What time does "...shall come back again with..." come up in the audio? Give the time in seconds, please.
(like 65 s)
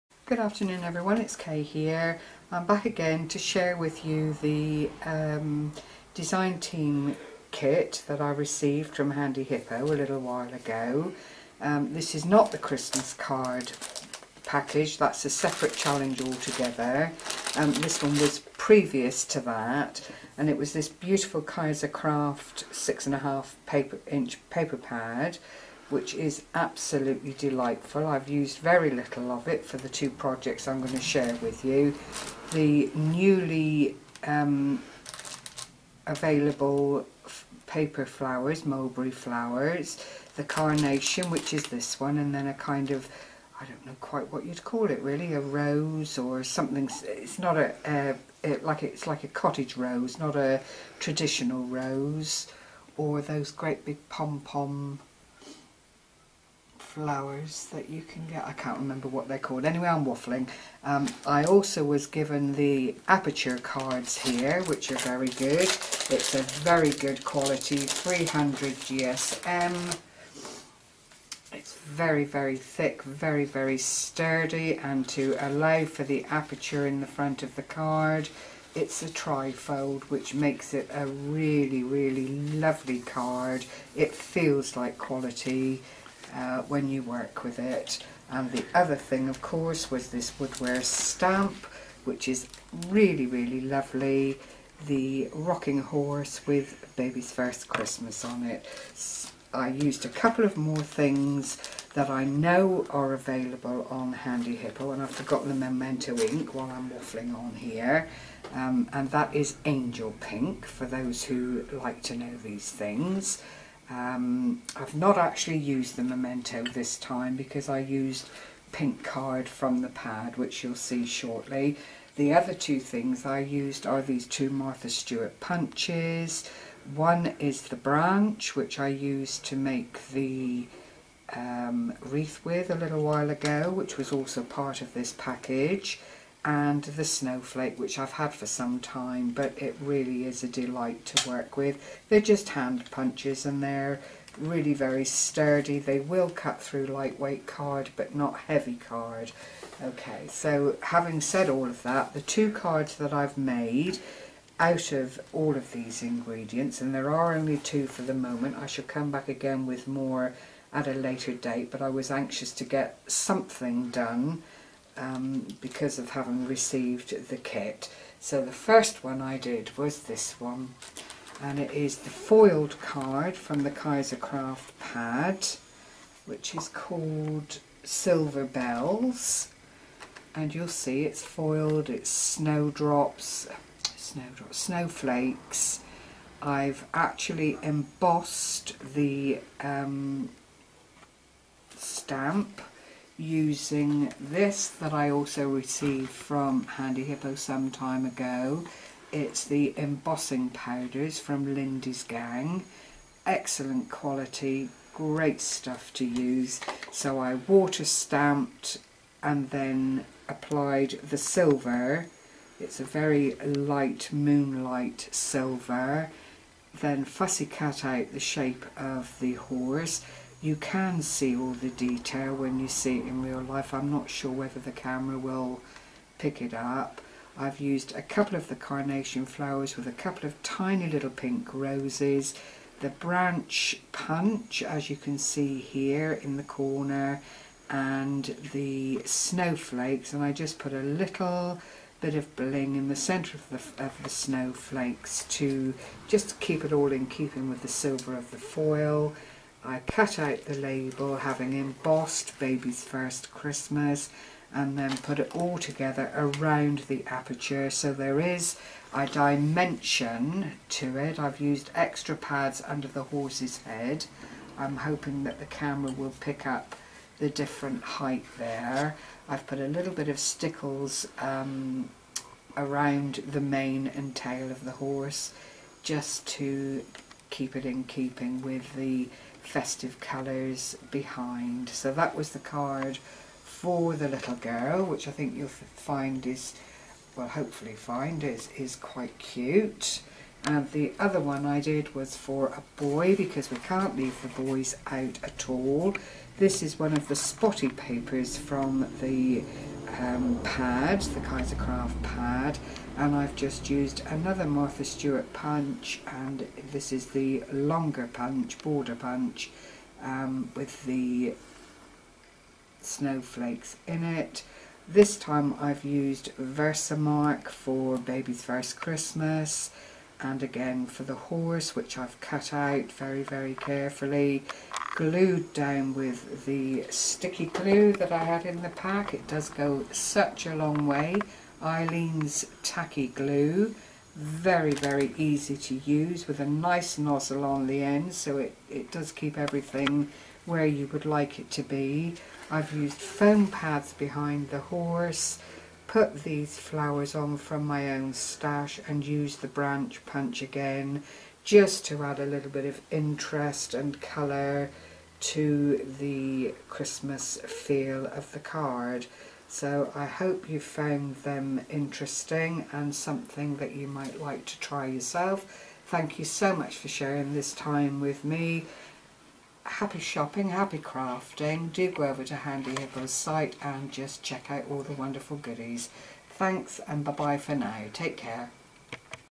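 158 s.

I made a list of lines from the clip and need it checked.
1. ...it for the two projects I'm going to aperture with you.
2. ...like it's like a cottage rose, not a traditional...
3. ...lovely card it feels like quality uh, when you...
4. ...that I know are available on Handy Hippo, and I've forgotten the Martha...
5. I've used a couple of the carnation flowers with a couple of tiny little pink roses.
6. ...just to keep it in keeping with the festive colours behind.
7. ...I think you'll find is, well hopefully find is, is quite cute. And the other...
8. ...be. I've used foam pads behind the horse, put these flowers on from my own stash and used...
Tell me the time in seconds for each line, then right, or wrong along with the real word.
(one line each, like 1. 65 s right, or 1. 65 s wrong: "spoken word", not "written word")
1. 29 s wrong: "share", not "aperture"
2. 48 s right
3. 82 s right
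4. 101 s wrong: "Memento", not "Martha"
5. 227 s right
6. 275 s right
7. 285 s right
8. 341 s right.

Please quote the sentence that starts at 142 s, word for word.
They're just hand punches and they're really very sturdy.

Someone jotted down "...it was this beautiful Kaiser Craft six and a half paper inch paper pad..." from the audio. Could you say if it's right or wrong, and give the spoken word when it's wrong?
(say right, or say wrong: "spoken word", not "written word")
right.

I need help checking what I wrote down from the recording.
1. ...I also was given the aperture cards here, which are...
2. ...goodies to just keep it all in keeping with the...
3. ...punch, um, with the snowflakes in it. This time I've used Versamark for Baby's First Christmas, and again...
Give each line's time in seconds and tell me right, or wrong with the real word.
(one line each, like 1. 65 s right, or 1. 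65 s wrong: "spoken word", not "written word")
1. 61 s right
2. 244 s wrong: "snowflakes", not "goodies"
3. 308 s right.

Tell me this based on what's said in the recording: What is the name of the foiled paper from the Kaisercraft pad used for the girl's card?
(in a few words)
Silver Bells.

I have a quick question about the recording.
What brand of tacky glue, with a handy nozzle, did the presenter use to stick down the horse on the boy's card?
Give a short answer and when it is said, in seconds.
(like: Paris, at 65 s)
Aleene's, at 331 s.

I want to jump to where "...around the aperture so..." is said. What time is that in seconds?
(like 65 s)
256 s.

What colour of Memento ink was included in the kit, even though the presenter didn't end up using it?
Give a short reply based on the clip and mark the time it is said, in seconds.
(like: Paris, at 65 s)
Angel Pink, at 109 s.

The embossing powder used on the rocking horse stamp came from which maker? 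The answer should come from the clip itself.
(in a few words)
Lindy's Gang.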